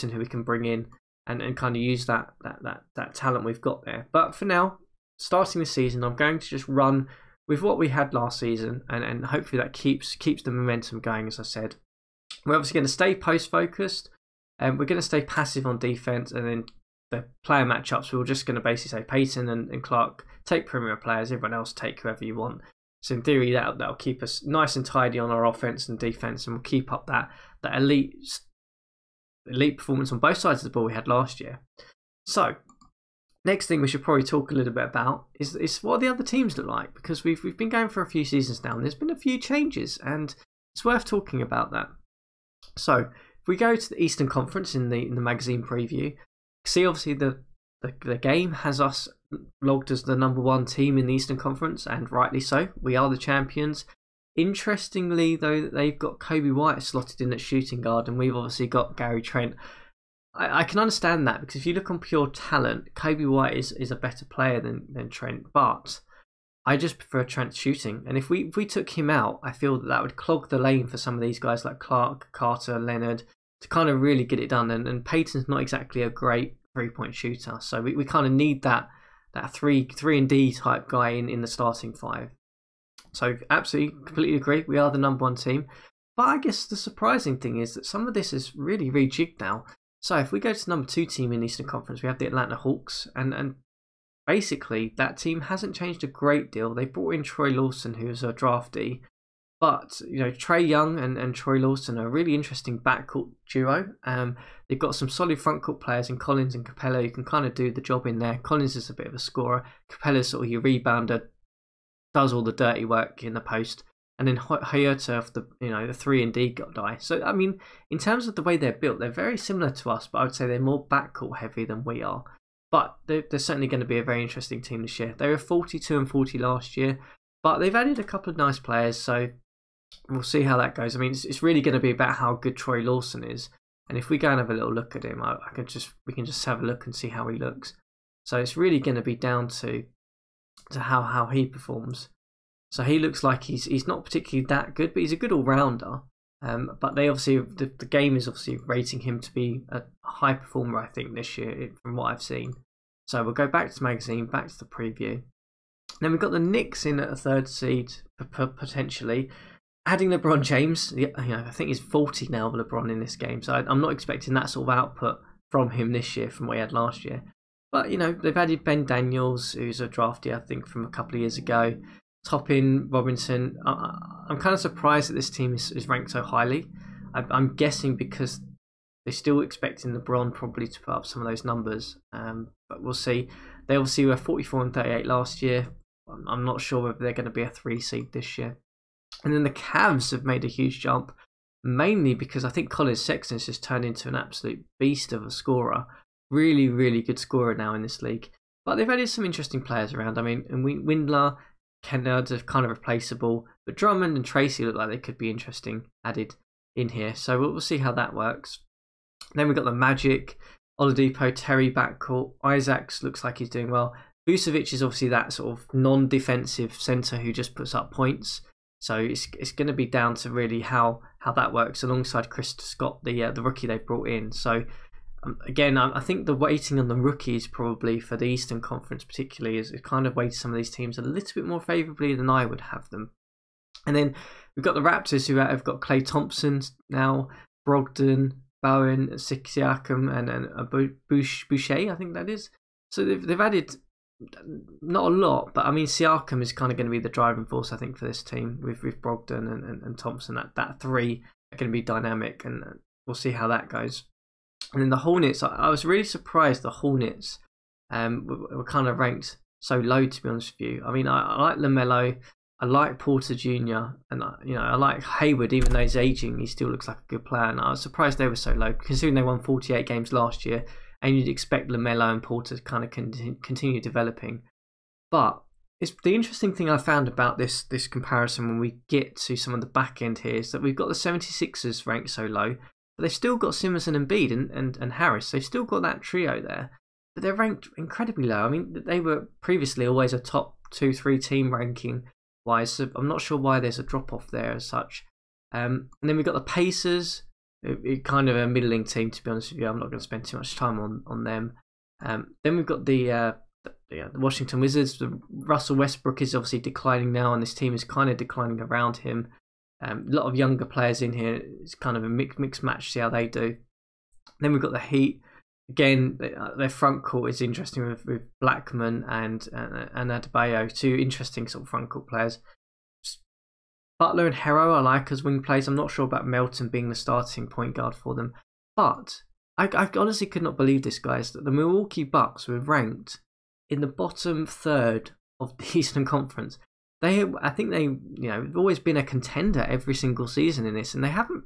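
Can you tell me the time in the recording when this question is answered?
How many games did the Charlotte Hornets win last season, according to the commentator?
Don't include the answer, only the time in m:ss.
4:29.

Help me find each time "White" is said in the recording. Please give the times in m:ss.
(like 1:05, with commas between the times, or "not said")
0:56, 1:03.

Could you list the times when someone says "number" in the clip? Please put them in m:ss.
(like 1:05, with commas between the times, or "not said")
0:50, 1:24, 1:30, 3:01.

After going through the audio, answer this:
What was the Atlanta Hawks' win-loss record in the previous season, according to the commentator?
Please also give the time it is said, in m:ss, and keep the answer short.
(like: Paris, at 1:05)
42-40, at 2:05.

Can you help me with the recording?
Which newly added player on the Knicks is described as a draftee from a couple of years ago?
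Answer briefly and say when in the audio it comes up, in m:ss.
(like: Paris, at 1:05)
Ben Daniels, at 2:48.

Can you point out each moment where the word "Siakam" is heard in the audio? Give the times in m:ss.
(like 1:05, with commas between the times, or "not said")
3:59, 4:05.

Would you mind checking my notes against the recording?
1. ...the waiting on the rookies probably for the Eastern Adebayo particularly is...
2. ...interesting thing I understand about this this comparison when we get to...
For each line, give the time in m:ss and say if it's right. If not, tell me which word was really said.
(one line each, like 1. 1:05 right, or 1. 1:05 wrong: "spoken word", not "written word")
1. 3:46 wrong: "Conference", not "Adebayo"
2. 4:36 wrong: "found", not "understand".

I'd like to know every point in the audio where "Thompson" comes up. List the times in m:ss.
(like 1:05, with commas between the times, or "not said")
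3:56, 4:09.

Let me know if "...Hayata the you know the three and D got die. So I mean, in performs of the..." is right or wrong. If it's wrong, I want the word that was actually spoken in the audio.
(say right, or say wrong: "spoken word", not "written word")
wrong: "terms", not "performs".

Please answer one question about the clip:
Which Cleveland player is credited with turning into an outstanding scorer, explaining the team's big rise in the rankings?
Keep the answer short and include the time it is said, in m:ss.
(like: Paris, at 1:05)
Collin Sexton, at 3:12.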